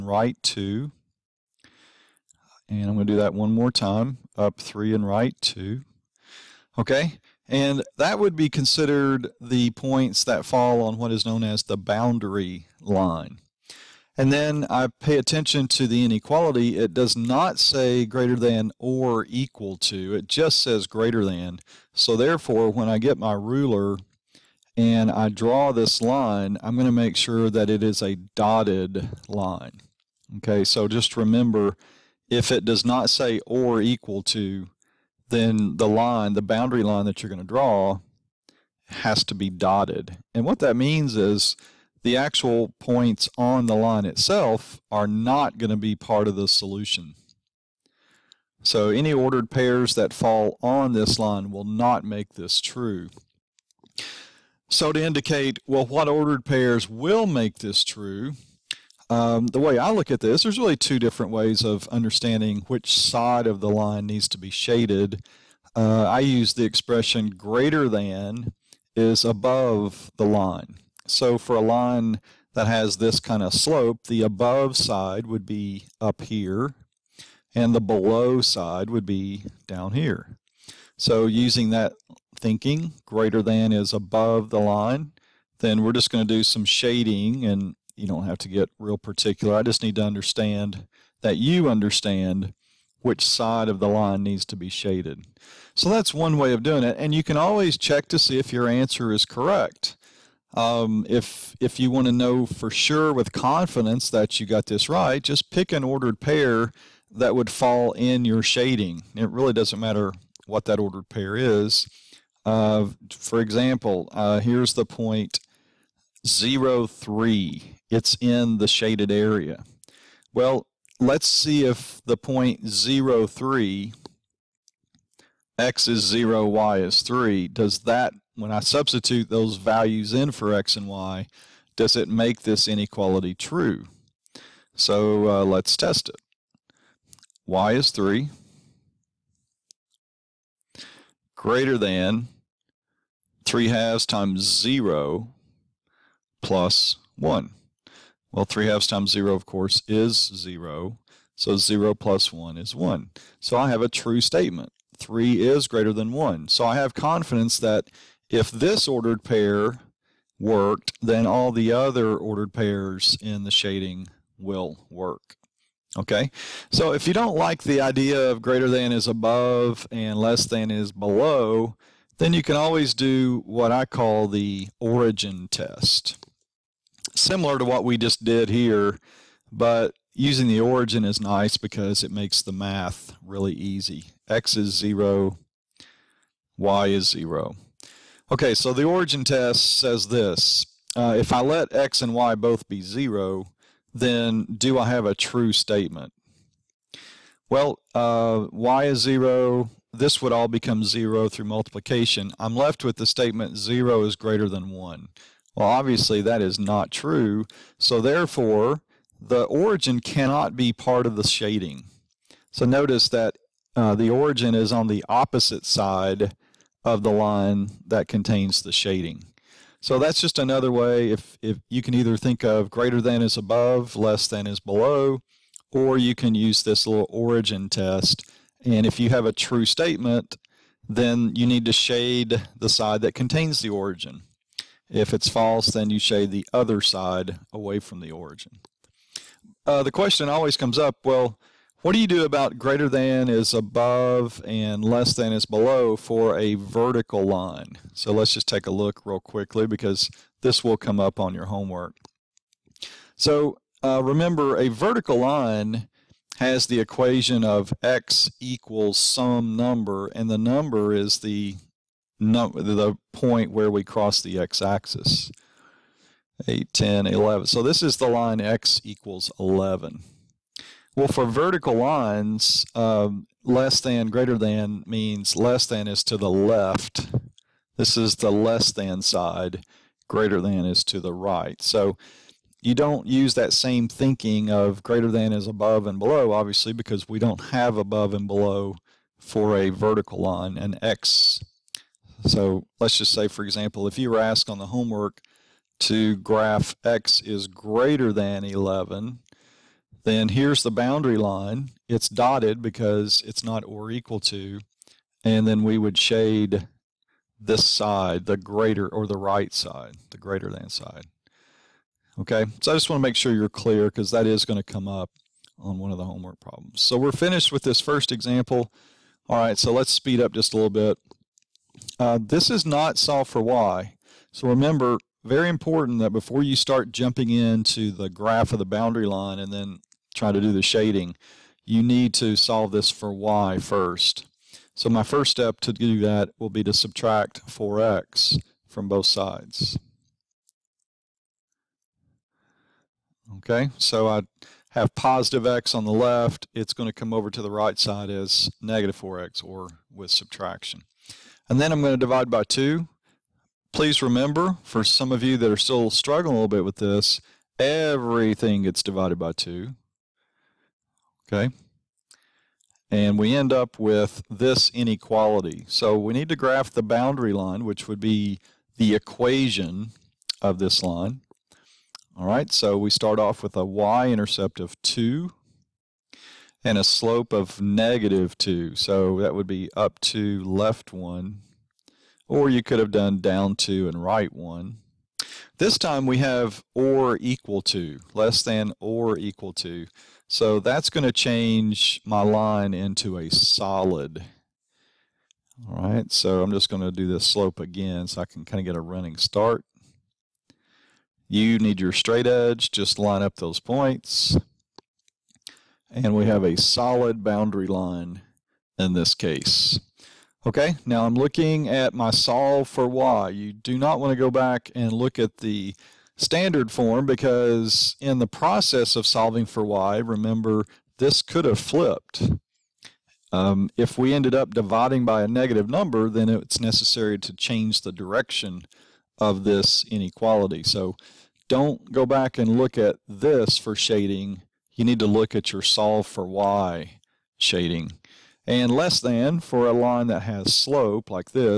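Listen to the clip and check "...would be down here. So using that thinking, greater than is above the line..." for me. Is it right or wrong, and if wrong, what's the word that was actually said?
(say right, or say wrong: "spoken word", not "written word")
right.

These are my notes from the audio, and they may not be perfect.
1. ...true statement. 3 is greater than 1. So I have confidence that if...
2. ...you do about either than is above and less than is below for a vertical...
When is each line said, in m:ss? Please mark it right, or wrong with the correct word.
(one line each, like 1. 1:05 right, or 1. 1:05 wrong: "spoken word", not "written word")
1. 2:33 right
2. 4:02 wrong: "greater", not "either".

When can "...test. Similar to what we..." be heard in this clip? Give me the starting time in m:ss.
2:55.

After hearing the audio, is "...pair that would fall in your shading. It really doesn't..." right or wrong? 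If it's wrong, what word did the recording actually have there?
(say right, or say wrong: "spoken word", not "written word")
right.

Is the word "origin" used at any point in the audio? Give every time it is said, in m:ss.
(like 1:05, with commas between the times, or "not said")
2:54, 3:00, 3:08, 3:29, 3:34, 3:47, 3:53, 3:58.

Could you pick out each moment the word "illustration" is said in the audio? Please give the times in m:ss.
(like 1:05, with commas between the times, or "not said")
not said.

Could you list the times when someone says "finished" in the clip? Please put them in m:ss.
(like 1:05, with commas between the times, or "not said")
5:17.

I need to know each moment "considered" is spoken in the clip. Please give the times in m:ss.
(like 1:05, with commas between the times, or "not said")
0:08.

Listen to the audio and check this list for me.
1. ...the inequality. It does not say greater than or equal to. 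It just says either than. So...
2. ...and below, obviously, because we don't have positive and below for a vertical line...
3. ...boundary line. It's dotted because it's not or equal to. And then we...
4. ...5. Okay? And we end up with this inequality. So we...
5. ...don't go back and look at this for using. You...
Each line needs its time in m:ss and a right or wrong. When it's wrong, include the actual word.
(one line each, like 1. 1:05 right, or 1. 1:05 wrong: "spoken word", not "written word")
1. 0:15 wrong: "greater", not "either"
2. 4:45 wrong: "above", not "positive"
3. 5:00 right
4. 5:59 wrong: "2", not "5"
5. 7:11 wrong: "shading", not "using".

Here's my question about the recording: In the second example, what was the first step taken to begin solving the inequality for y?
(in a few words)
subtract 4x.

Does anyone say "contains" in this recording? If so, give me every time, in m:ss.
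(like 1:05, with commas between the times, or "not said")
3:38, 3:53.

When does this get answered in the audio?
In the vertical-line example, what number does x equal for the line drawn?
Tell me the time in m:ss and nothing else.
4:28.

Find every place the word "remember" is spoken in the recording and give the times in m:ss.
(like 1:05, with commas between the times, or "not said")
0:31, 4:14, 5:24, 5:54, 6:59.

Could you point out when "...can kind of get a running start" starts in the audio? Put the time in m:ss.
6:38.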